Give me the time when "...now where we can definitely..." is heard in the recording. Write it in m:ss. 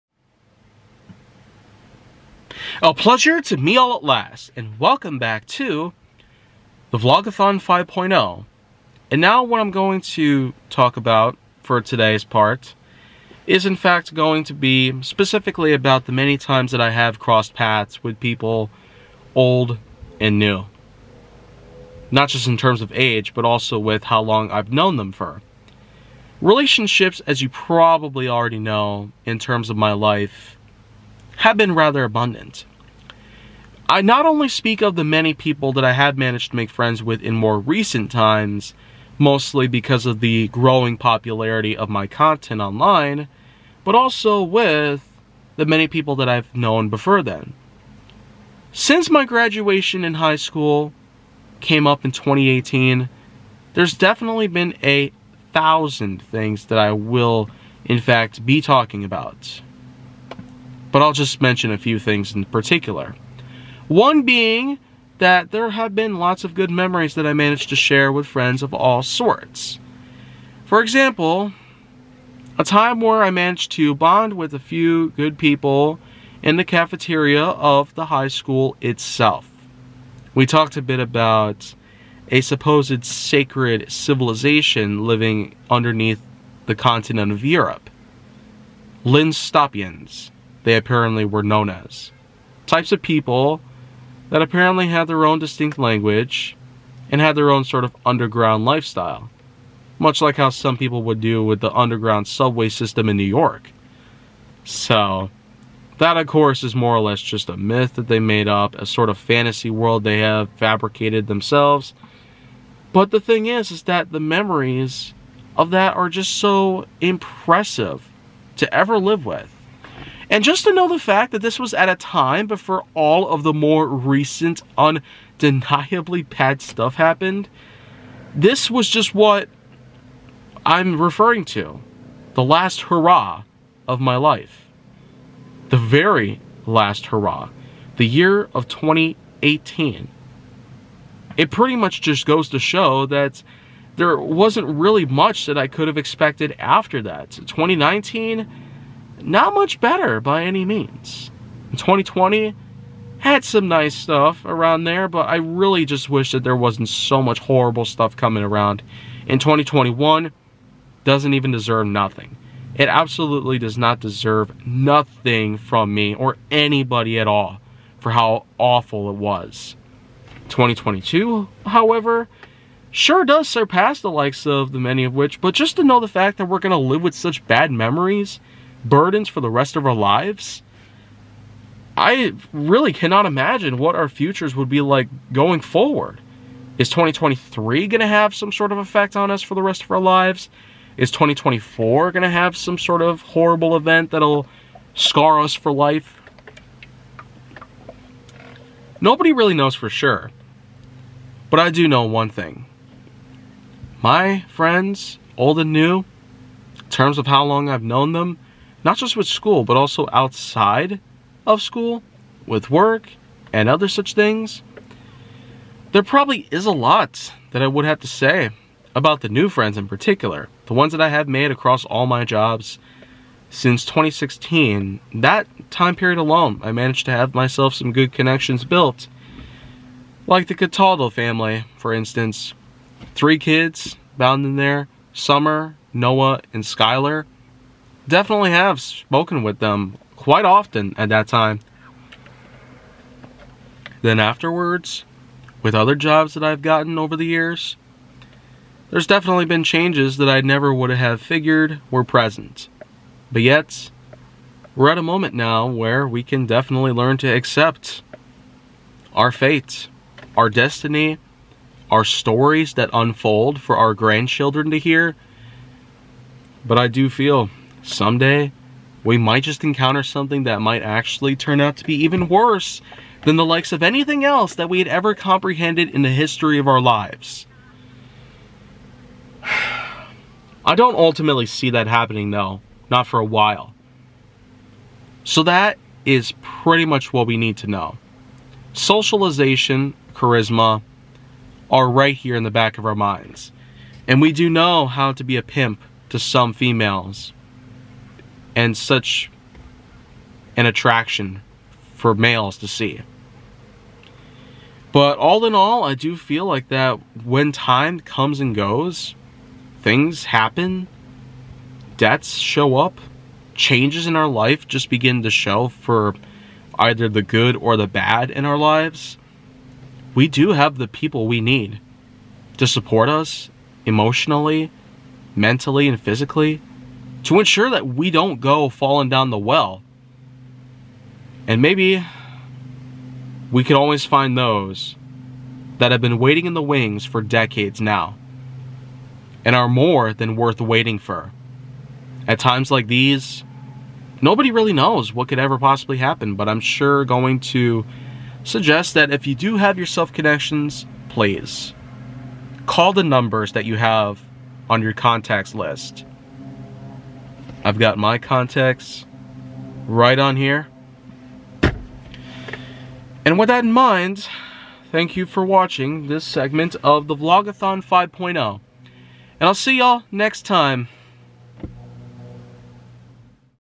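4:15.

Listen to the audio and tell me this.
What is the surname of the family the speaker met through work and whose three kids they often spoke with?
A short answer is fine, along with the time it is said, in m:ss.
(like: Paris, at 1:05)
Cataldo, at 3:50.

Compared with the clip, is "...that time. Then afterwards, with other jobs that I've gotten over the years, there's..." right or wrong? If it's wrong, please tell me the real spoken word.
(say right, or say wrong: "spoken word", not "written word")
right.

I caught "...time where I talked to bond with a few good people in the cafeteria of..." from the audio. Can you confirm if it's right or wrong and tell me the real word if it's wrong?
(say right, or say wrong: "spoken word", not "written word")
wrong: "managed", not "talked".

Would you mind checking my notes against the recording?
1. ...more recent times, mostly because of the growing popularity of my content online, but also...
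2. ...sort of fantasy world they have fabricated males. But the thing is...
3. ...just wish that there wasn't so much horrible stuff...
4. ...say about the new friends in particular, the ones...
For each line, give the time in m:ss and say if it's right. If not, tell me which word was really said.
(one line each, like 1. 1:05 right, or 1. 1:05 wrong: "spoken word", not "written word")
1. 0:37 right
2. 1:48 wrong: "themselves", not "males"
3. 2:35 right
4. 3:38 right.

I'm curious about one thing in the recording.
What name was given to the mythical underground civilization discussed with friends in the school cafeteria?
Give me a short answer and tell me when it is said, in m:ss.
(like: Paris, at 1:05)
Linstopians, at 1:29.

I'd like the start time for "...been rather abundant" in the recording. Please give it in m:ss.
0:31.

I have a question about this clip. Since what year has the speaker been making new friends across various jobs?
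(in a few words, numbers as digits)
2016.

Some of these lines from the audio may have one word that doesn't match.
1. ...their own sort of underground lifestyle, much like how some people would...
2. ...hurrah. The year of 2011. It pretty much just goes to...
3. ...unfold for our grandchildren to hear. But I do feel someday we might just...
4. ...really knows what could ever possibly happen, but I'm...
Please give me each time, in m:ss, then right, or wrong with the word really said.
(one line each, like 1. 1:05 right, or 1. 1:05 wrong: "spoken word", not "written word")
1. 1:37 right
2. 2:17 wrong: "2018", not "2011"
3. 4:22 right
4. 5:44 right.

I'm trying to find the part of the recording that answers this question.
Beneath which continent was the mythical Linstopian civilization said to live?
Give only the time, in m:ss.
1:27.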